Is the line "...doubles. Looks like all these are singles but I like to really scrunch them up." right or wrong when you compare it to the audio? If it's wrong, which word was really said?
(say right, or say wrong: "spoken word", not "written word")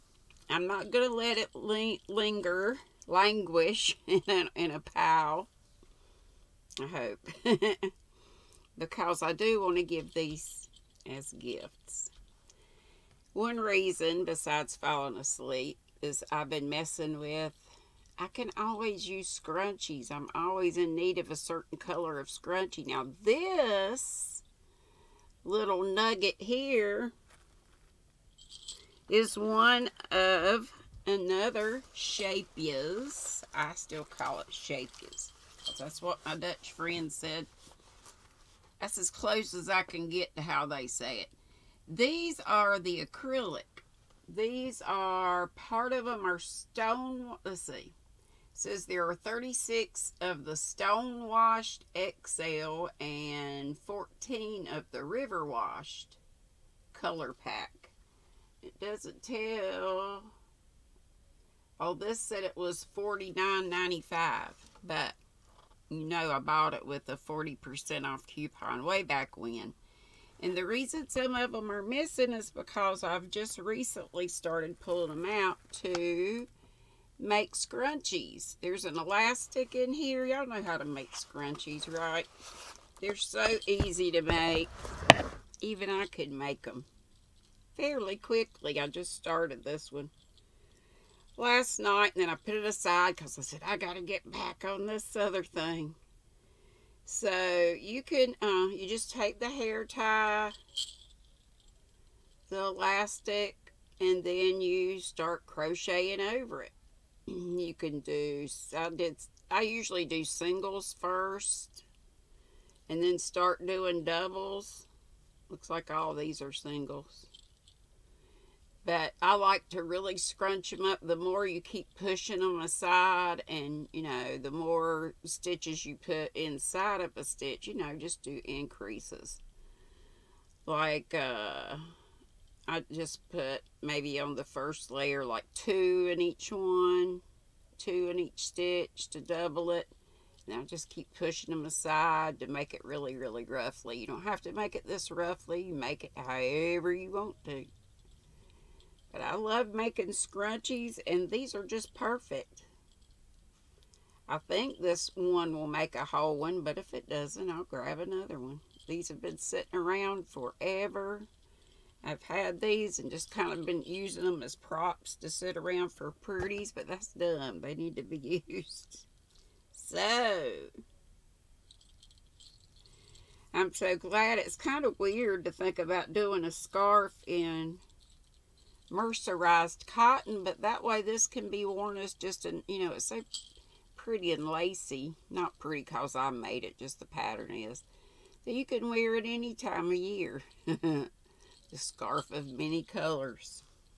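right.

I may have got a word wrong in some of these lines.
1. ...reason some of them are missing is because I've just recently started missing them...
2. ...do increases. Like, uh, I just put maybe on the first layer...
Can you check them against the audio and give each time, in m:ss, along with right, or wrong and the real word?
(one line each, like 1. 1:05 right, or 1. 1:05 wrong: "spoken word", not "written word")
1. 1:10 wrong: "pulling", not "missing"
2. 2:08 right.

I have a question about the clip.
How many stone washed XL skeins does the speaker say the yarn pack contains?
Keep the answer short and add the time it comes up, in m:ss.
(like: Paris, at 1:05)
36, at 0:49.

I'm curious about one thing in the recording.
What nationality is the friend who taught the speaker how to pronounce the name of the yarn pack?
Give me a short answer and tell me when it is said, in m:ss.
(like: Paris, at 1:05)
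Dutch, at 0:36.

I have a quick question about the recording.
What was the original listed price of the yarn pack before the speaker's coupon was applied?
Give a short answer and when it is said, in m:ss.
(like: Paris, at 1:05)
$49.95, at 1:02.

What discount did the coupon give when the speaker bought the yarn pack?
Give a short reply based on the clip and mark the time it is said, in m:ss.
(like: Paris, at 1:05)
40% off, at 1:07.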